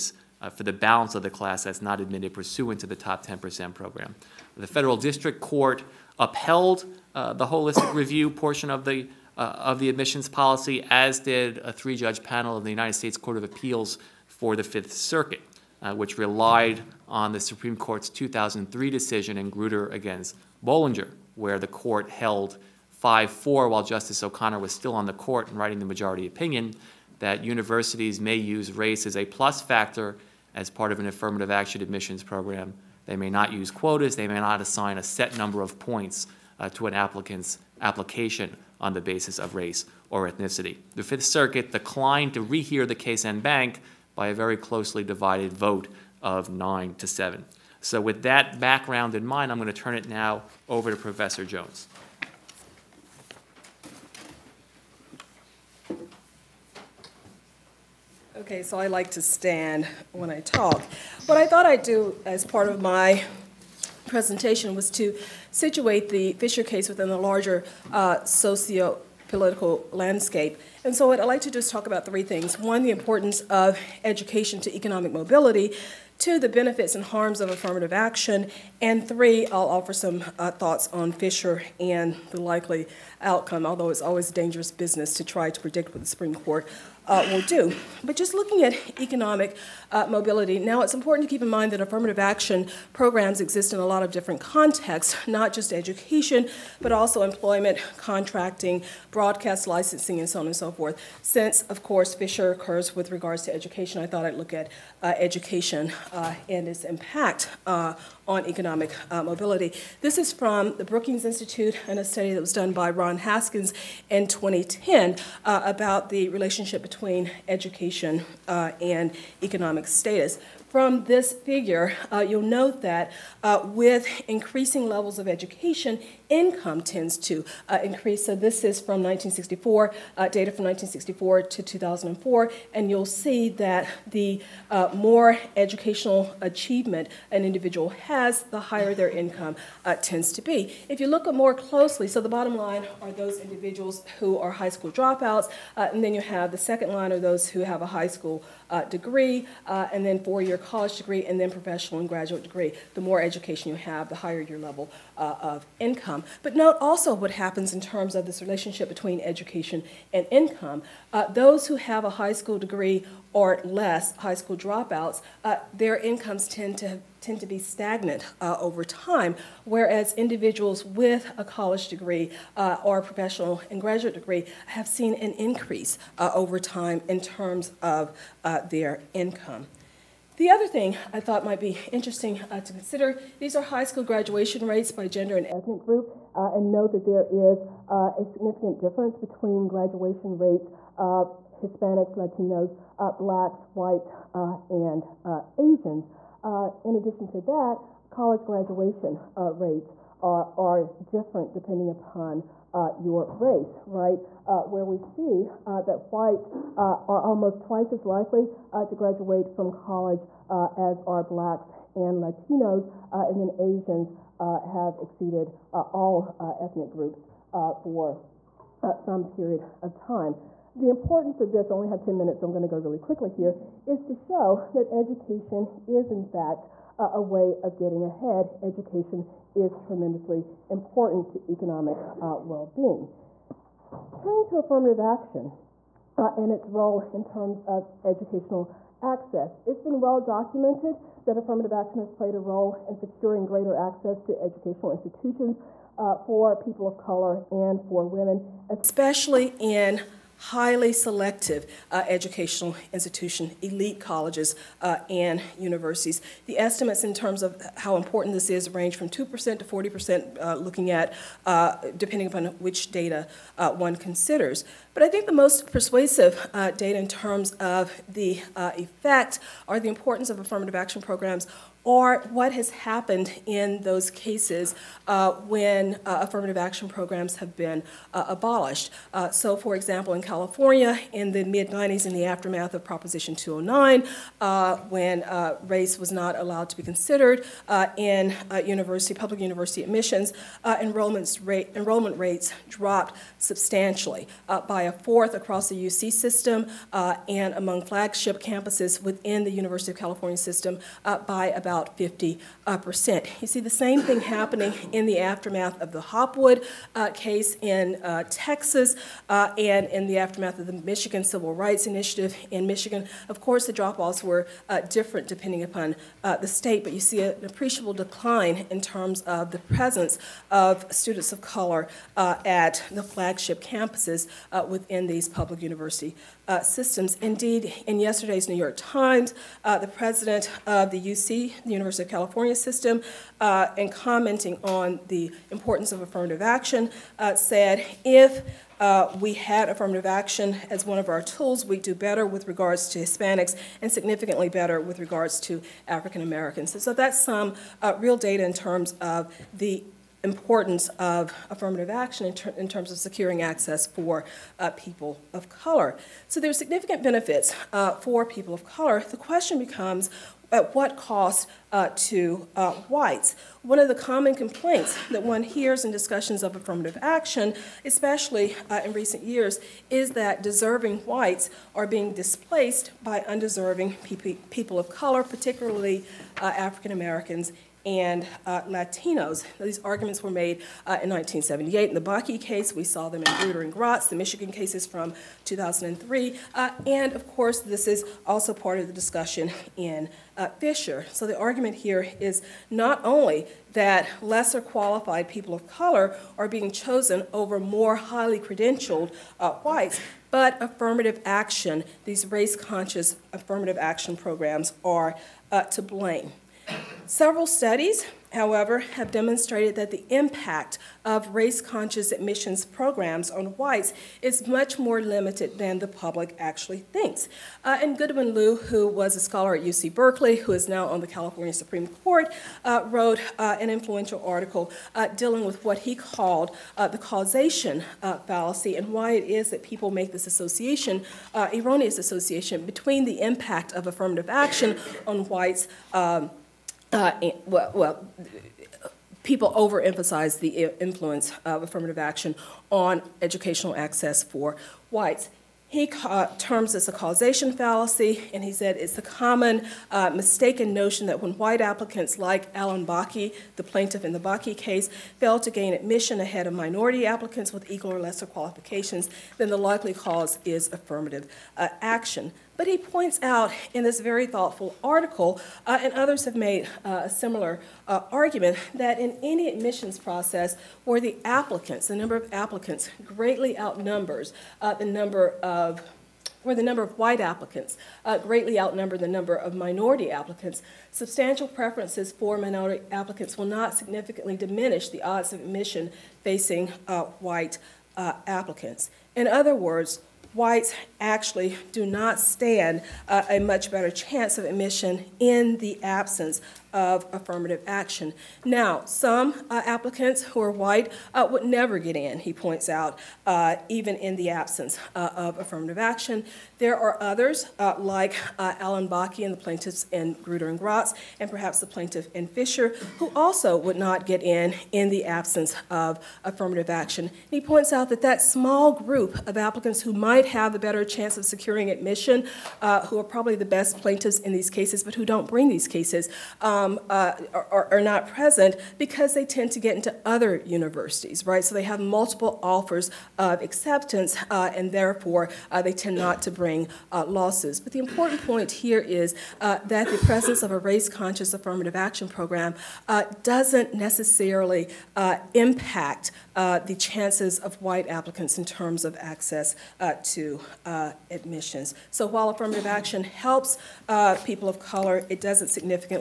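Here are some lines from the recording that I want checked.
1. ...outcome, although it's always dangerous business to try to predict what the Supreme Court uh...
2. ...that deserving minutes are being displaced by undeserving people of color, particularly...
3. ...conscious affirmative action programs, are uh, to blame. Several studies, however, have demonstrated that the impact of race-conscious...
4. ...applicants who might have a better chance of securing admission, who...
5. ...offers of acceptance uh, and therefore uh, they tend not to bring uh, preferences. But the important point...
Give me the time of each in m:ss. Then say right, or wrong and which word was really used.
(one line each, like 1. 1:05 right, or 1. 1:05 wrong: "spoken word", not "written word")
1. 1:23 right
2. 6:10 wrong: "whites", not "minutes"
3. 6:42 right
4. 8:39 right
5. 8:52 wrong: "losses", not "preferences".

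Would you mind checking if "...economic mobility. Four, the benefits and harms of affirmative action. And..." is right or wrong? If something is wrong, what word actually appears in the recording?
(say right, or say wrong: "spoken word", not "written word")
wrong: "Two", not "Four".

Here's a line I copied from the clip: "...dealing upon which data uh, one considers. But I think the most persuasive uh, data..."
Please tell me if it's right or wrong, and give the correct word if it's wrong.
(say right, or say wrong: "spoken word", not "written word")
wrong: "depending", not "dealing".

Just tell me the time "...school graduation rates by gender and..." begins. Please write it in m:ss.
3:03.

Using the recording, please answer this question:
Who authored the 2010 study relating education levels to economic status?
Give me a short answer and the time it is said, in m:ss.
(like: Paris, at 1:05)
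Ron Haskins, at 1:52.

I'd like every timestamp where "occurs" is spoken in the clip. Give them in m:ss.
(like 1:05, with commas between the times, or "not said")
1:42.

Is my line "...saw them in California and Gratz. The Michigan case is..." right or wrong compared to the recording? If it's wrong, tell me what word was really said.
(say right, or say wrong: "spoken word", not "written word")
wrong: "Grutter", not "California".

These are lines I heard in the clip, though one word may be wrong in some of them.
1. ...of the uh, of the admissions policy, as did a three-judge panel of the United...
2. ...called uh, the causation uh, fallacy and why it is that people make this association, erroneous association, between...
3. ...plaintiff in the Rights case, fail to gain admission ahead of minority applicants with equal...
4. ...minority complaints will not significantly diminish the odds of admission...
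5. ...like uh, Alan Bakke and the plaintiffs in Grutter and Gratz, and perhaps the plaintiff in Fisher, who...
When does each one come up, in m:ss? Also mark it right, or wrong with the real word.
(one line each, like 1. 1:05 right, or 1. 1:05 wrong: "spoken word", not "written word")
1. 0:08 right
2. 7:05 right
3. 7:33 wrong: "Bakke", not "Rights"
4. 8:02 wrong: "applicants", not "complaints"
5. 8:27 right.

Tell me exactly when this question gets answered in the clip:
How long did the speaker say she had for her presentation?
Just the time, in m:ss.
3:41.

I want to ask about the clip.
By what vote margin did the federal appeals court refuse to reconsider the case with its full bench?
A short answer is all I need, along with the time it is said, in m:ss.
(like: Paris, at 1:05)
9 to 7, at 0:46.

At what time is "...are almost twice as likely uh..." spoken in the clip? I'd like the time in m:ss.
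3:27.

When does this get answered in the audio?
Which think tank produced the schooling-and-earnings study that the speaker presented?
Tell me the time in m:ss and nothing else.
1:50.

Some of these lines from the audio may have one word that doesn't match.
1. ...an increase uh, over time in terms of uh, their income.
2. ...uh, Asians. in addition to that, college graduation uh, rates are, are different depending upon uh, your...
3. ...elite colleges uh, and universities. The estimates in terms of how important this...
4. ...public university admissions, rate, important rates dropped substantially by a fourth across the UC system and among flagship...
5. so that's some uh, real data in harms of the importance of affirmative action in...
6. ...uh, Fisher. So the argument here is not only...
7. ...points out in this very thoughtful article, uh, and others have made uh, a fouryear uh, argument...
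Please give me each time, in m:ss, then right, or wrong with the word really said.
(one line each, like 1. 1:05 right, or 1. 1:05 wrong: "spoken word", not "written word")
1. 2:55 right
2. 3:15 right
3. 4:13 right
4. 4:49 wrong: "enrollment", not "important"
5. 5:46 wrong: "terms", not "harms"
6. 6:30 right
7. 7:42 wrong: "similar", not "fouryear".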